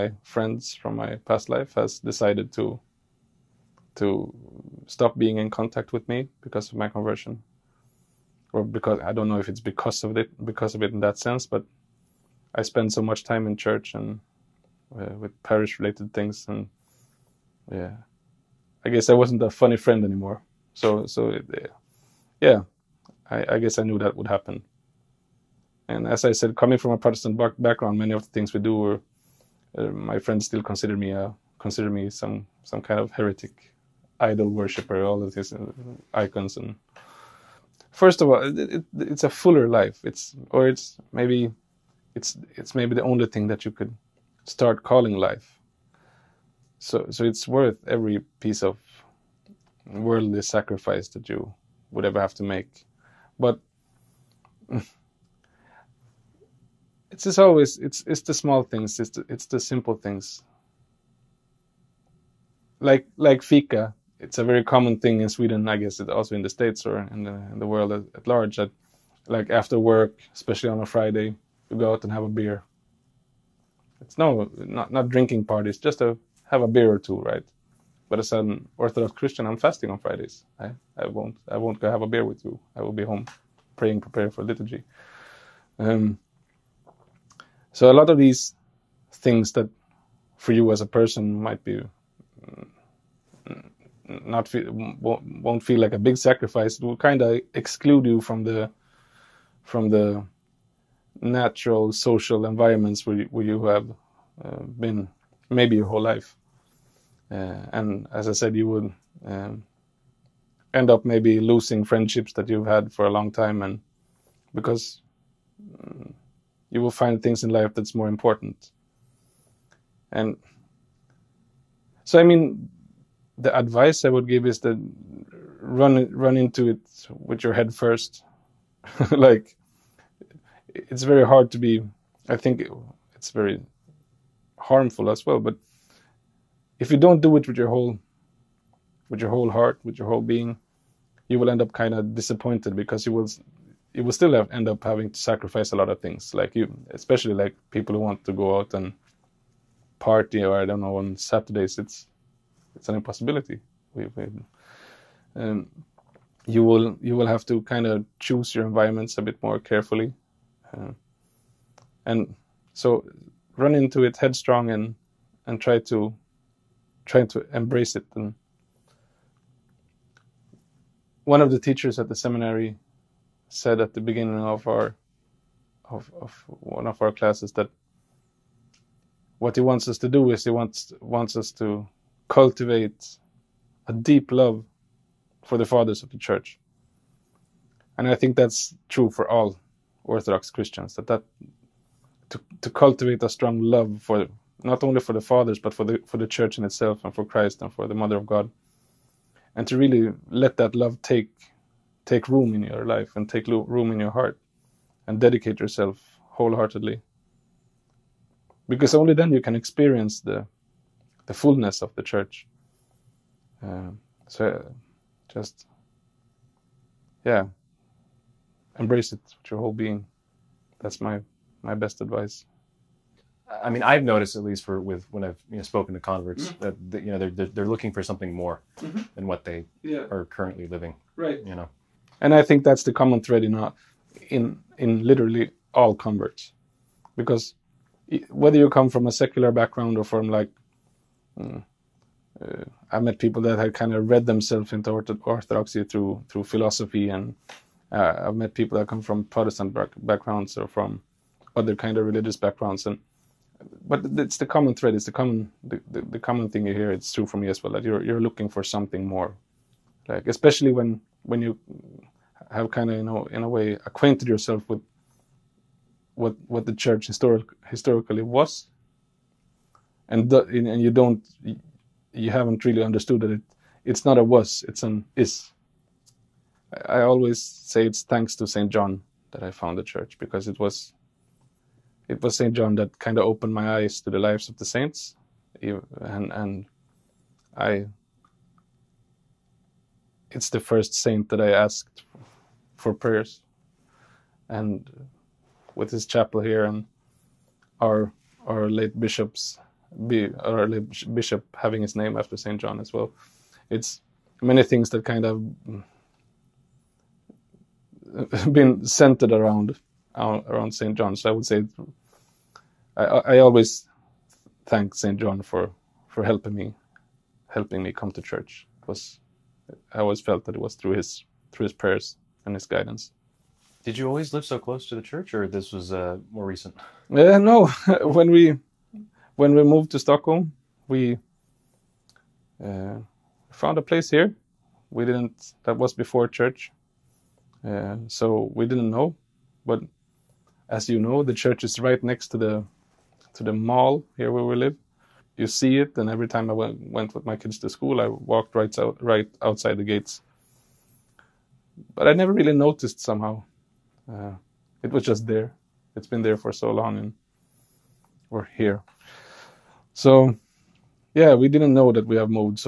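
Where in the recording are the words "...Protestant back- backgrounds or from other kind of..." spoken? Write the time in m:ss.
4:09.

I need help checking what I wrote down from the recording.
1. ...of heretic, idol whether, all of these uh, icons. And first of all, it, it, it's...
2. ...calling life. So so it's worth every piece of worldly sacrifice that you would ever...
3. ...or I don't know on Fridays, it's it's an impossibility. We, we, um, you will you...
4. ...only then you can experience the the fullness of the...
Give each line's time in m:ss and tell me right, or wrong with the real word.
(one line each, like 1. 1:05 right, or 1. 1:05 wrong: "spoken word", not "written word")
1. 0:32 wrong: "worshipper", not "whether"
2. 0:44 right
3. 2:30 wrong: "Saturdays", not "Fridays"
4. 3:28 right.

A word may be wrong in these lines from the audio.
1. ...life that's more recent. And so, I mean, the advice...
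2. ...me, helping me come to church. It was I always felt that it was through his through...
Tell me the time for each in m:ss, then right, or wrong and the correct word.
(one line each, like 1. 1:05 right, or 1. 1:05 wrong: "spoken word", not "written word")
1. 1:57 wrong: "important", not "recent"
2. 5:16 right.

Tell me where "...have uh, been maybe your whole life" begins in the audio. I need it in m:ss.
1:43.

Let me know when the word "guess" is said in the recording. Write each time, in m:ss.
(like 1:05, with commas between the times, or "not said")
0:18, 0:23, 1:05.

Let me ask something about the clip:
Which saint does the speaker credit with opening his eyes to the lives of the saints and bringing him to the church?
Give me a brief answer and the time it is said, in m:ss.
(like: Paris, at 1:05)
Saint John, at 4:38.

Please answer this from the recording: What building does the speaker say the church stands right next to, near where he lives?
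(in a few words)
The mall.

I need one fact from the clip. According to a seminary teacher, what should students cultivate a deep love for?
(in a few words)
The fathers of the church.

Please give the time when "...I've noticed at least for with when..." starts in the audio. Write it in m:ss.
3:43.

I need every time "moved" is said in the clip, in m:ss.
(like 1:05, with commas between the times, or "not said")
5:29.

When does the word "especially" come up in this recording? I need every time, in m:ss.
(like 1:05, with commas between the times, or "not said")
1:10, 2:26, 4:20.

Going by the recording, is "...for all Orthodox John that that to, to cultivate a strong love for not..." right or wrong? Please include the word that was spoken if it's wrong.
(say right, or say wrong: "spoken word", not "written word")
wrong: "Christians", not "John".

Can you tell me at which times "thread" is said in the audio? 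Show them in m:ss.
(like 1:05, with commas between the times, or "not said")
3:53, 4:14.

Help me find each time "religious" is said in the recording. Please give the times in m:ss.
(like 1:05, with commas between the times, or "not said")
4:12.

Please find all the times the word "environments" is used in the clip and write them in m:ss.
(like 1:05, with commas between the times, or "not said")
1:42, 2:38.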